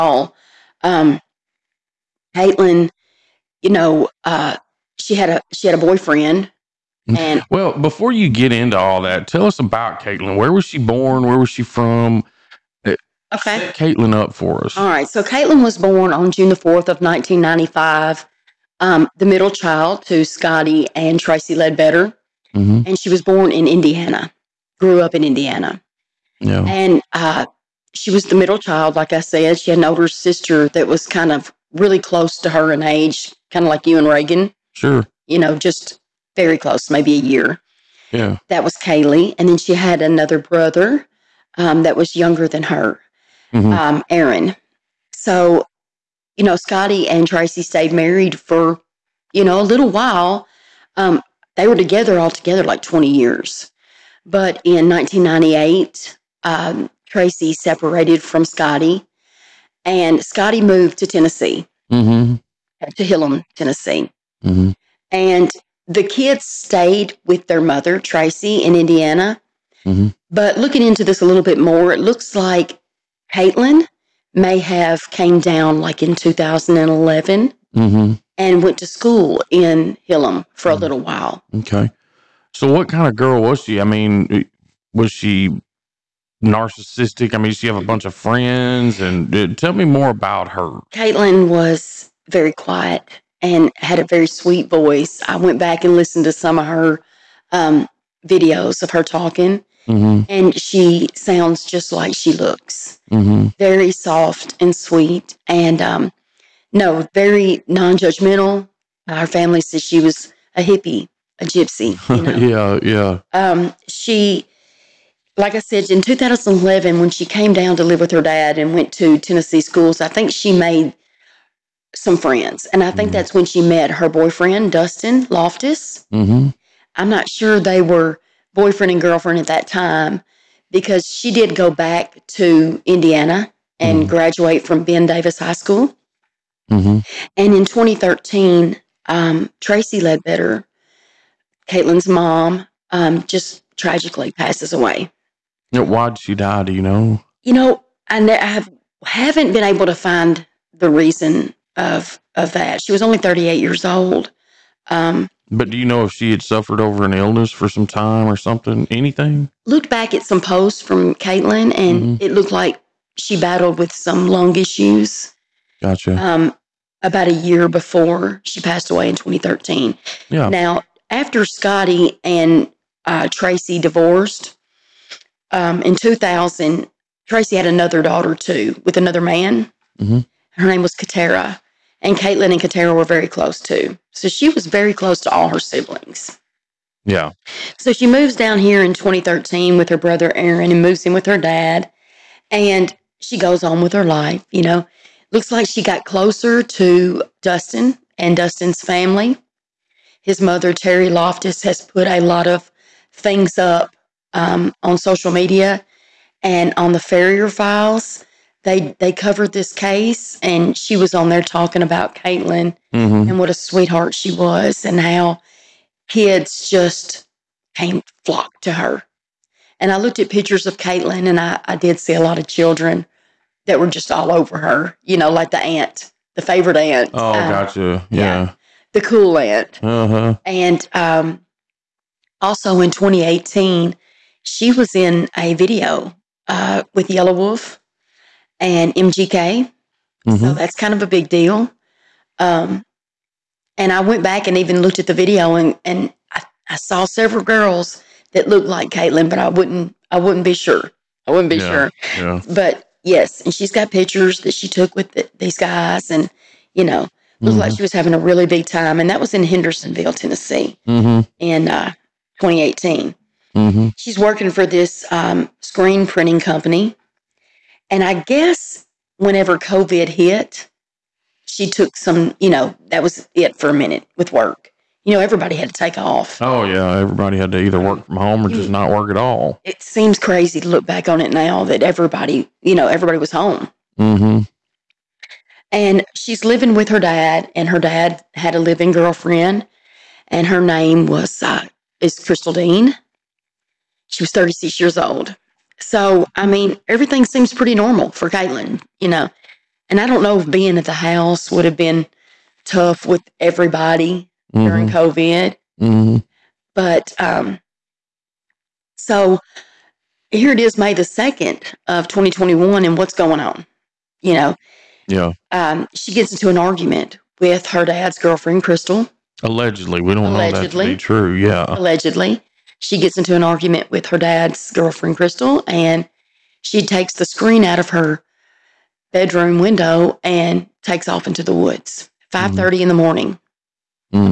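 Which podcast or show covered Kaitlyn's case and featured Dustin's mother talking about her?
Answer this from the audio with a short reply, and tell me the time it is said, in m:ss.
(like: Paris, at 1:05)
Farrier files, at 3:26.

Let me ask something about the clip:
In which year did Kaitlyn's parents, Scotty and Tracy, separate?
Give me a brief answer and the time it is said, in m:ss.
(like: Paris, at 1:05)
1998, at 0:54.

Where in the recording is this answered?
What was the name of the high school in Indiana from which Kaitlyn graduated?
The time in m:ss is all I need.
2:14.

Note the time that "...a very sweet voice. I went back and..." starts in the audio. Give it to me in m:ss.
1:33.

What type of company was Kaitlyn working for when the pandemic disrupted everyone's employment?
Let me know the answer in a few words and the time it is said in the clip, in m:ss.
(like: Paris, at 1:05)
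screen printing, at 4:25.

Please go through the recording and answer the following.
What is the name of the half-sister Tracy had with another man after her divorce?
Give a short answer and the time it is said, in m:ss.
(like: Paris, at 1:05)
Katara, at 3:00.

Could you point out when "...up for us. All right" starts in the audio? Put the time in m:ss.
0:14.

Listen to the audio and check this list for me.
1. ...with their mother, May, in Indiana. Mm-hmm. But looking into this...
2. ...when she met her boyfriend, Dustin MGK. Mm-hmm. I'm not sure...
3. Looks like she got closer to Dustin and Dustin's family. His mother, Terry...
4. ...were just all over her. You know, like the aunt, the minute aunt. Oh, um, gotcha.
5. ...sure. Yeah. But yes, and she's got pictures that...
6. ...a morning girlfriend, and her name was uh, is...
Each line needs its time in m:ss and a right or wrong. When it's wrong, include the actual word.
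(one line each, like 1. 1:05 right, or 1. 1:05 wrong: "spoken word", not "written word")
1. 1:07 wrong: "Tracy", not "May"
2. 2:03 wrong: "Loftus", not "MGK"
3. 3:15 right
4. 3:43 wrong: "favorite", not "minute"
5. 4:11 right
6. 4:48 wrong: "living", not "morning".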